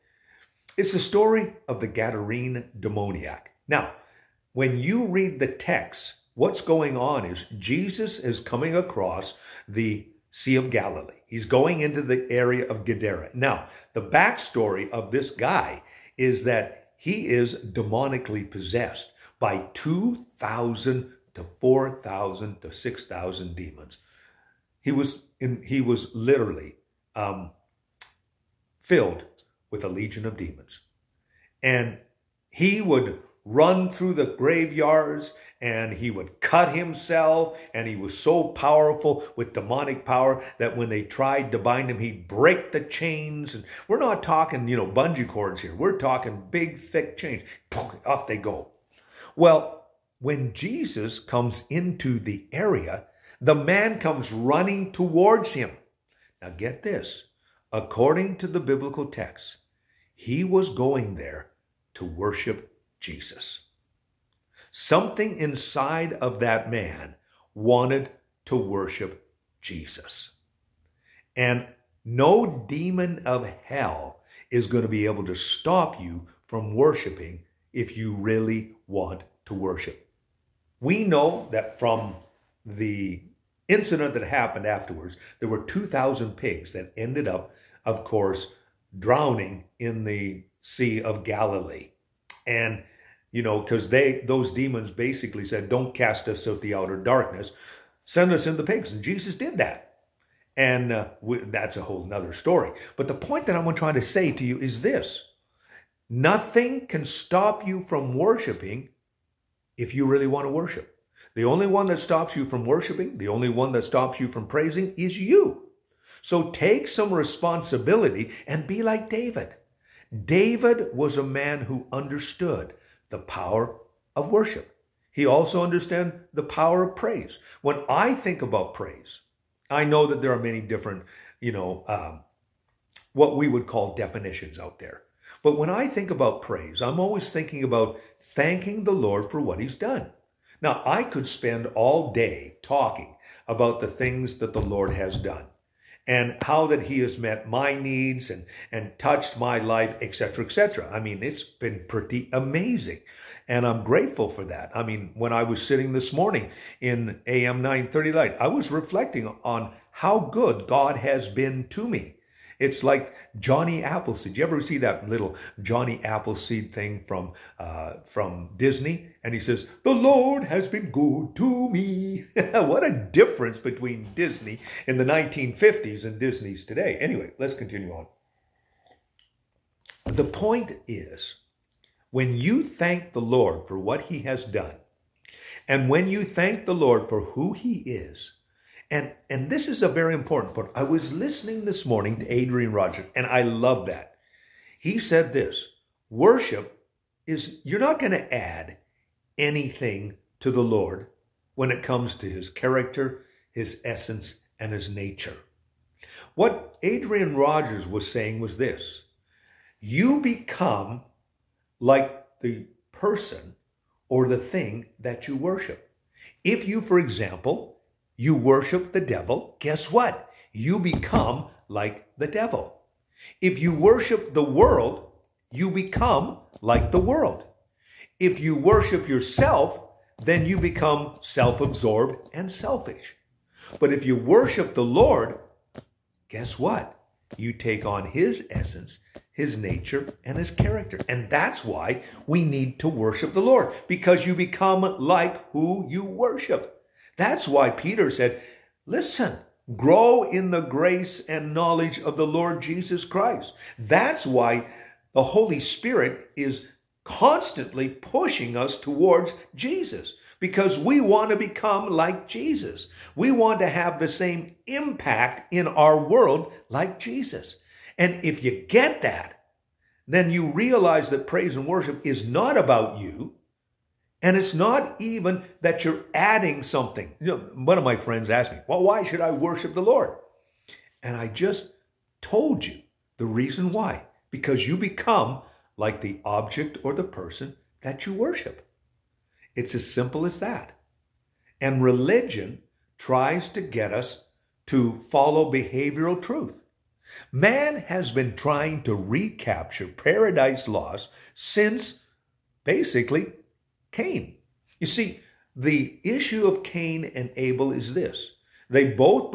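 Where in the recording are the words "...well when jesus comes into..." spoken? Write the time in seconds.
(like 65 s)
49 s.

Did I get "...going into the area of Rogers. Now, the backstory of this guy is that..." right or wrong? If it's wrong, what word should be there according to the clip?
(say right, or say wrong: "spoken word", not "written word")
wrong: "Gadara", not "Rogers".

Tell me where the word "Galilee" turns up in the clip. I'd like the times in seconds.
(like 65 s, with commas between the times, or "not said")
10 s, 91 s.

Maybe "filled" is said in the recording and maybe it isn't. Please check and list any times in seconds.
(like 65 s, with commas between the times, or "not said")
28 s.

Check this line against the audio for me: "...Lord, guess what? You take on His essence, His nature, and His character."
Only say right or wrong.
right.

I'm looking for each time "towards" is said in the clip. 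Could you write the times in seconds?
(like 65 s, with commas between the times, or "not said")
54 s, 258 s.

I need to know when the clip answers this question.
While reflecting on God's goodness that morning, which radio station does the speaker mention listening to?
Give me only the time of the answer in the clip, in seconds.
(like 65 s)
157 s.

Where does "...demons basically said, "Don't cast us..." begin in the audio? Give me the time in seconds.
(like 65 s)
94 s.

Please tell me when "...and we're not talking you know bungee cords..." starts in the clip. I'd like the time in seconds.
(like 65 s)
43 s.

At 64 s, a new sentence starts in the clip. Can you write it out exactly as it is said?
Something inside of that man wanted to worship Jesus.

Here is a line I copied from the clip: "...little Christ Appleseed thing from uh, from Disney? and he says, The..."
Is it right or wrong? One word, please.
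wrong.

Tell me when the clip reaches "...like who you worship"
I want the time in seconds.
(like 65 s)
244 s.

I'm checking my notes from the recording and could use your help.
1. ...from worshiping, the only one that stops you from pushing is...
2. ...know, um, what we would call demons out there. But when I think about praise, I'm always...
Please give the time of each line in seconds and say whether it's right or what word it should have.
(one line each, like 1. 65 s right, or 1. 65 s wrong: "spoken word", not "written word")
1. 112 s wrong: "praising", not "pushing"
2. 131 s wrong: "definitions", not "demons".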